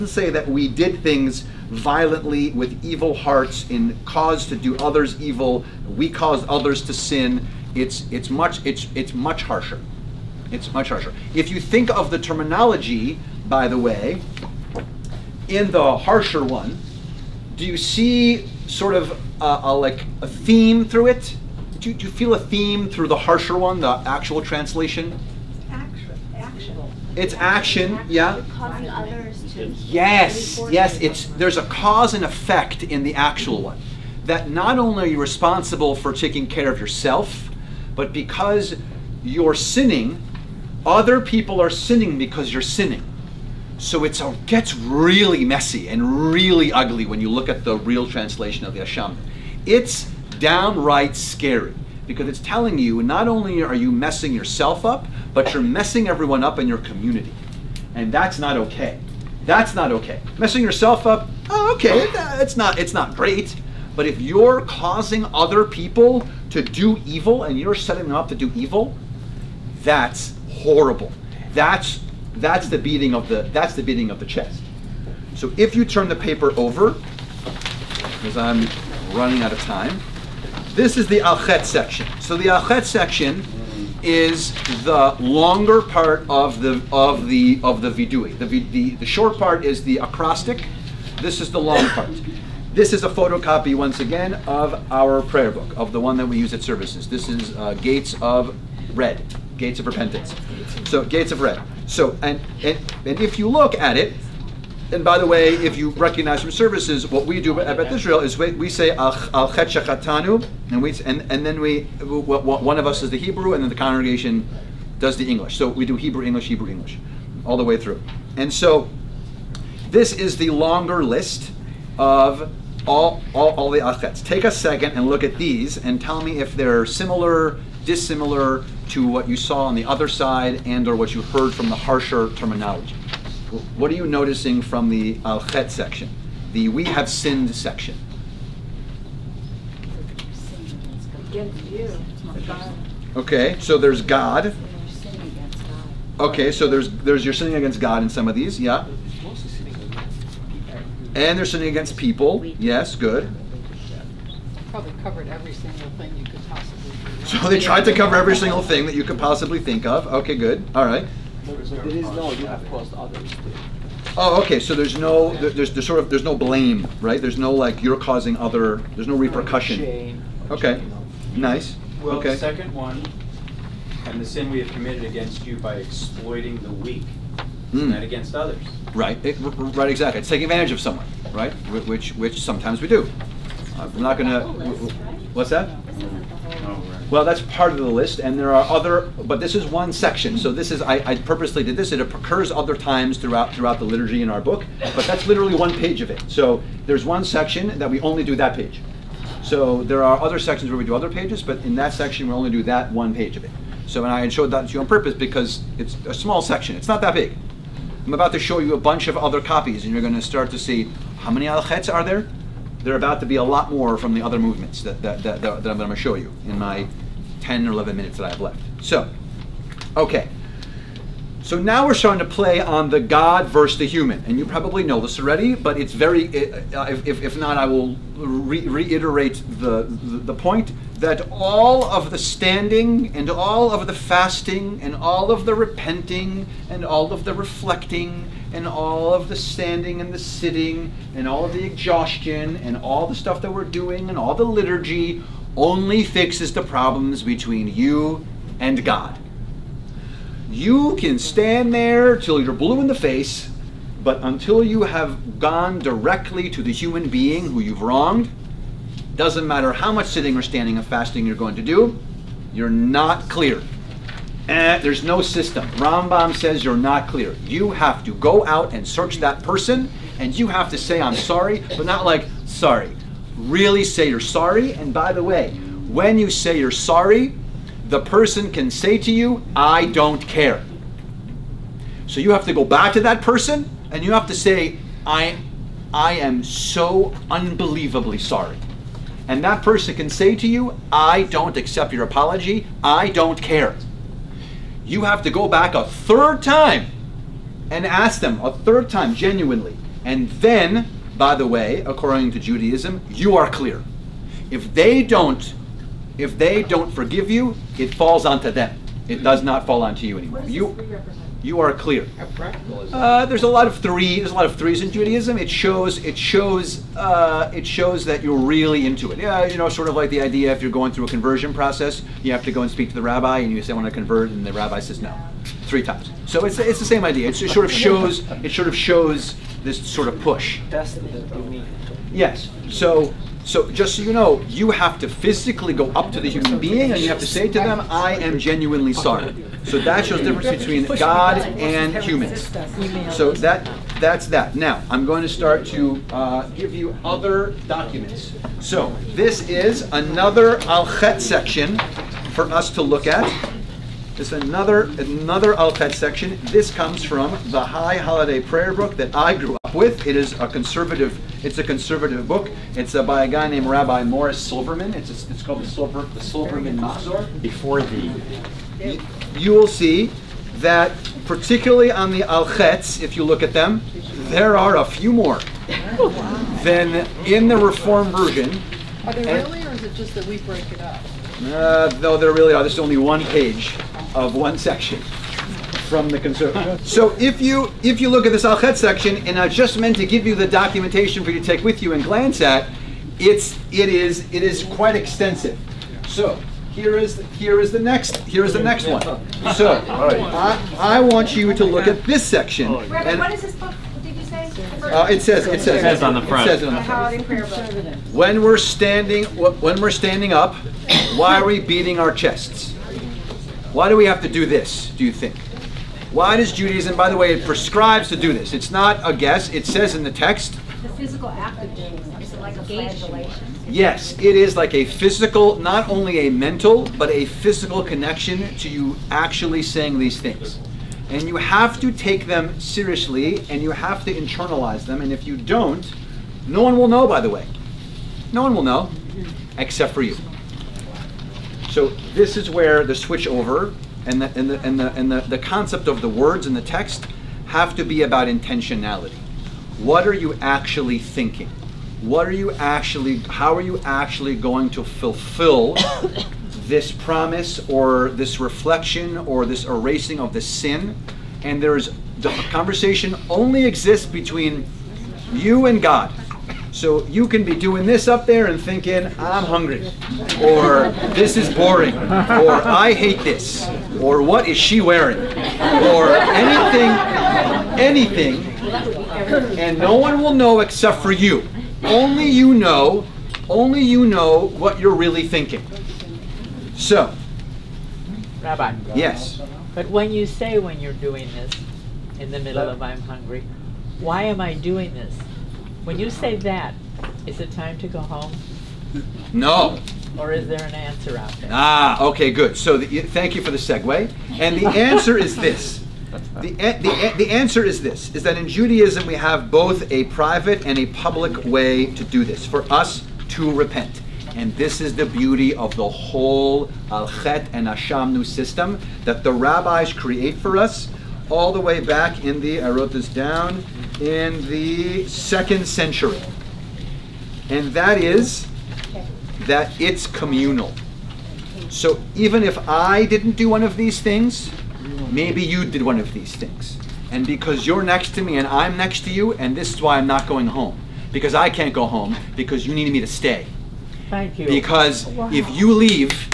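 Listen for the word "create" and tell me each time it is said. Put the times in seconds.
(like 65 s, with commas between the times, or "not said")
519 s.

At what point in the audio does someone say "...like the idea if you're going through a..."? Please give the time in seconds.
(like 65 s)
319 s.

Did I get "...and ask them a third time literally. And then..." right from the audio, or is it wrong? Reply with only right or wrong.
wrong.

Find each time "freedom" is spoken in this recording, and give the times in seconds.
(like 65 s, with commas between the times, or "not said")
not said.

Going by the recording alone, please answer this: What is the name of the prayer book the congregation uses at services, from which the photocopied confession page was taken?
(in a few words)
Gates of Repentance.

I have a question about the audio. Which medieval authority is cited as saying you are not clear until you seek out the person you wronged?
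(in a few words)
Rambam.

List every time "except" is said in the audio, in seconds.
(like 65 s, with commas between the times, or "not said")
439 s, 480 s.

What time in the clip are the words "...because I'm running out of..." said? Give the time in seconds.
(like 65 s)
78 s.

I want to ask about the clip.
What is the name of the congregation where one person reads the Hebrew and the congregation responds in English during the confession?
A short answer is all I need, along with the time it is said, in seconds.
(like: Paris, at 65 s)
Beth Israel, at 107 s.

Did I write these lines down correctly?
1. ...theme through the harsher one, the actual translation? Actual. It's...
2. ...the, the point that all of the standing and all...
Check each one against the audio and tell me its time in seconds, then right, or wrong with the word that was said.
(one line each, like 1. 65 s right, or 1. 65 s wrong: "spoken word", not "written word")
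1. 22 s right
2. 229 s right.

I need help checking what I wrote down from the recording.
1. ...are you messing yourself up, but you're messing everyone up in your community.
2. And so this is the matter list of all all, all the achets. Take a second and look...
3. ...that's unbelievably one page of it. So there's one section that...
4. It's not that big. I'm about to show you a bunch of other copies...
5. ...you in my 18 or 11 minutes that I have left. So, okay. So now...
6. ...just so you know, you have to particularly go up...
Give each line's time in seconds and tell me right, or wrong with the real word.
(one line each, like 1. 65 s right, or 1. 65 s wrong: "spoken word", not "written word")
1. 53 s right
2. 118 s wrong: "longer", not "matter"
3. 195 s wrong: "literally", not "unbelievably"
4. 206 s right
5. 216 s wrong: "10", not "18"
6. 333 s wrong: "physically", not "particularly".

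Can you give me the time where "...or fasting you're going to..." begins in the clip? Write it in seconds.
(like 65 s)
260 s.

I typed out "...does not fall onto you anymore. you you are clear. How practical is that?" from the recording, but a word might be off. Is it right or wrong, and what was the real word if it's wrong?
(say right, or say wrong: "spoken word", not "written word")
right.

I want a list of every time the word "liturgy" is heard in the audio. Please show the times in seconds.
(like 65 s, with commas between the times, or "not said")
193 s, 244 s.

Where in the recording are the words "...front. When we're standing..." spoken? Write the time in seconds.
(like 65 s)
406 s.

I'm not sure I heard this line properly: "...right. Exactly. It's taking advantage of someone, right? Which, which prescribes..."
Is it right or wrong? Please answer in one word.
wrong.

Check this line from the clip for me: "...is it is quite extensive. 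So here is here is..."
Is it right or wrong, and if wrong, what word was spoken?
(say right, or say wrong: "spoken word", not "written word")
right.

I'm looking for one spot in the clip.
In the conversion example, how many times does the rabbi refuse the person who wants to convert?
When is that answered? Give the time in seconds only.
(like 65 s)
325 s.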